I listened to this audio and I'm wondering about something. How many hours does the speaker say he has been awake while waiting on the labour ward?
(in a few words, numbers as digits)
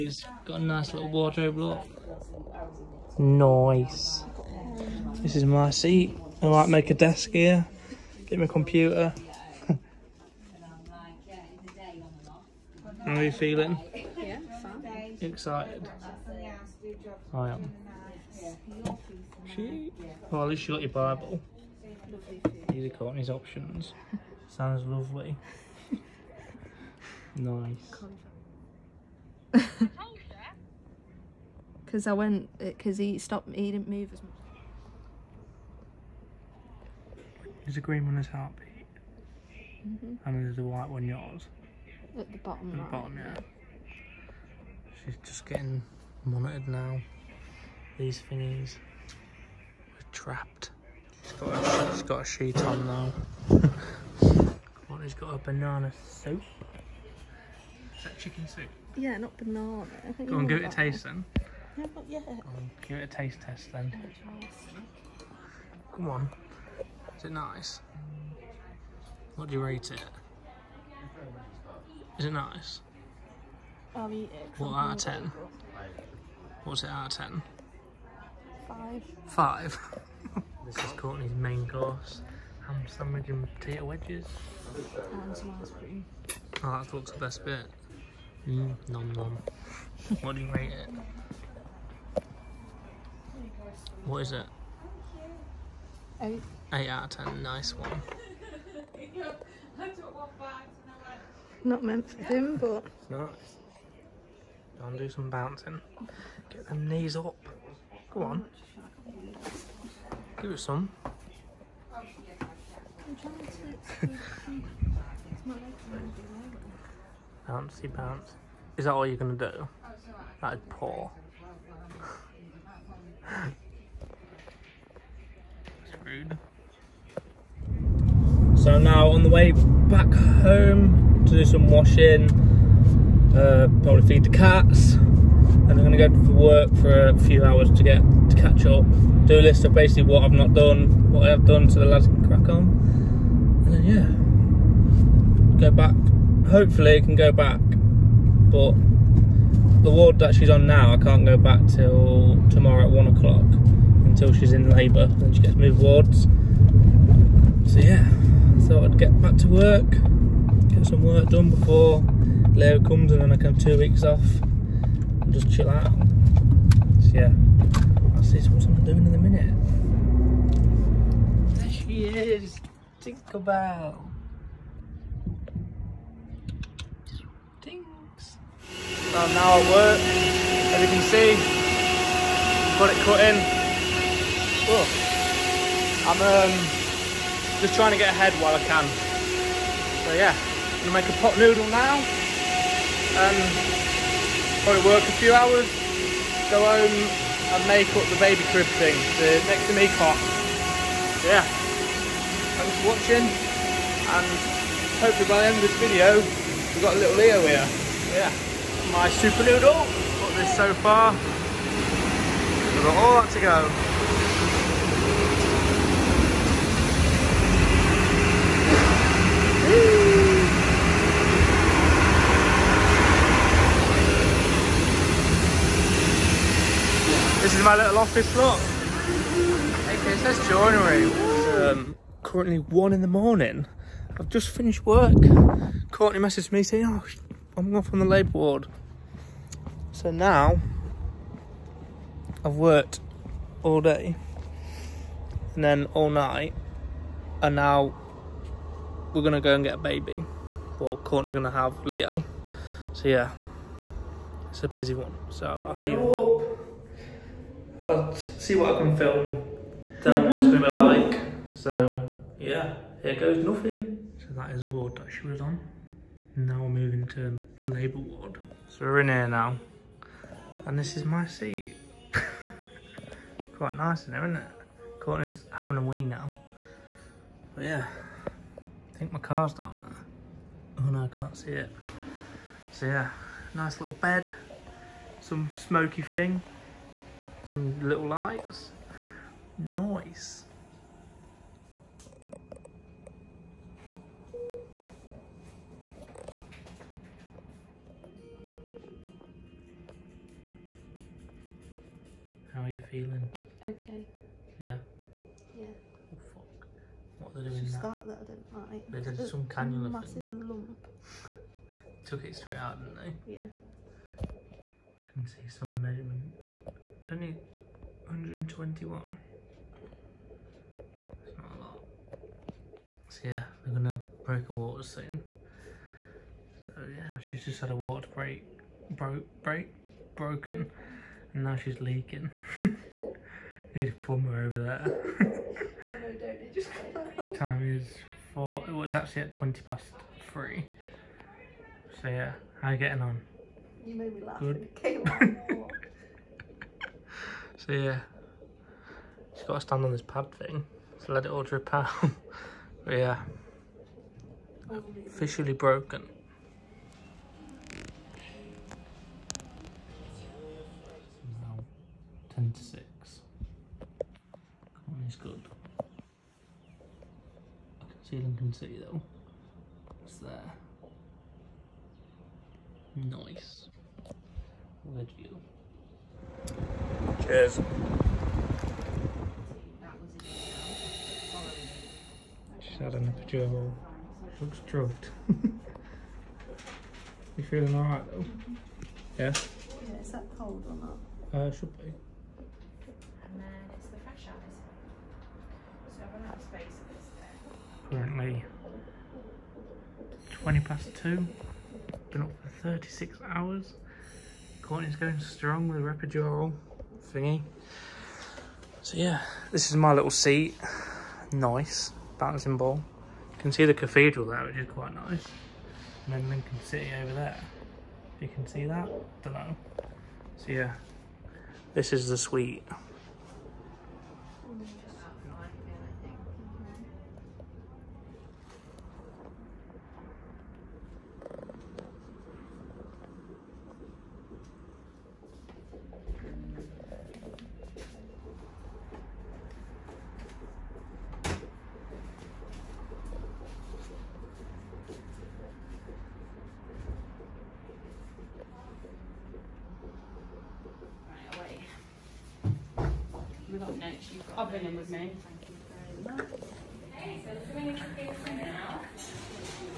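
36.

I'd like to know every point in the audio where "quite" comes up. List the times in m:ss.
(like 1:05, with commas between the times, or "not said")
4:33, 6:54.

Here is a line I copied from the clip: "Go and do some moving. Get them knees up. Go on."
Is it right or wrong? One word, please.
wrong.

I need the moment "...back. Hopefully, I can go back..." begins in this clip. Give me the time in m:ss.
2:25.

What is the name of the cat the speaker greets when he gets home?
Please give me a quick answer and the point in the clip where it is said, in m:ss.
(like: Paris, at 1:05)
Tinkerbell, at 2:53.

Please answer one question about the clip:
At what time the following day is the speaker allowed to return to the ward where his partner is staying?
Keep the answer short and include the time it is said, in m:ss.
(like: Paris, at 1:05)
1 o'clock, at 2:32.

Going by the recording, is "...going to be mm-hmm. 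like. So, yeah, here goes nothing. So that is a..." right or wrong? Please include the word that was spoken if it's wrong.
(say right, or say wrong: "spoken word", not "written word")
right.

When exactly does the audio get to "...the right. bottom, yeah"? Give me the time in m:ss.
0:42.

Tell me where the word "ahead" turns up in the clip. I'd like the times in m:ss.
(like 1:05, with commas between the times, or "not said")
3:08.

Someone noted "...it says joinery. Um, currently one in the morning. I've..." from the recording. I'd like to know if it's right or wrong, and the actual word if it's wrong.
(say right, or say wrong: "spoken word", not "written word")
right.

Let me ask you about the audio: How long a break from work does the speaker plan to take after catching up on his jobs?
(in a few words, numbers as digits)
2 weeks.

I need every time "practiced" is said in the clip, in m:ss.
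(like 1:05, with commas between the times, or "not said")
not said.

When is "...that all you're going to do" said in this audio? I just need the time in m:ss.
1:58.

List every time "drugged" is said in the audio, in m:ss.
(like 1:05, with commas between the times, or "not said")
6:24.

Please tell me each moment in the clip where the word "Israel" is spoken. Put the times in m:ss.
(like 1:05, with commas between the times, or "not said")
not said.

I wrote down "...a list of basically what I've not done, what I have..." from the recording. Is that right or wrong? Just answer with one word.
right.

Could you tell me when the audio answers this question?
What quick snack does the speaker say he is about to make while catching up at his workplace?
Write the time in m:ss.
3:11.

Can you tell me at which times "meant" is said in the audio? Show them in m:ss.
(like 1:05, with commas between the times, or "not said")
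1:41.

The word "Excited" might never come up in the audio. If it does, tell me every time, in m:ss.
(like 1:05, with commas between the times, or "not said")
0:15.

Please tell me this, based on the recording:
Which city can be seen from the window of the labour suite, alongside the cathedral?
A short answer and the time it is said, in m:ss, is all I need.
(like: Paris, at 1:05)
Lincoln, at 6:56.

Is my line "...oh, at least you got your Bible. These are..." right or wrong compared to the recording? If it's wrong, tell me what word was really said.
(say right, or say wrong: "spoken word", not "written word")
right.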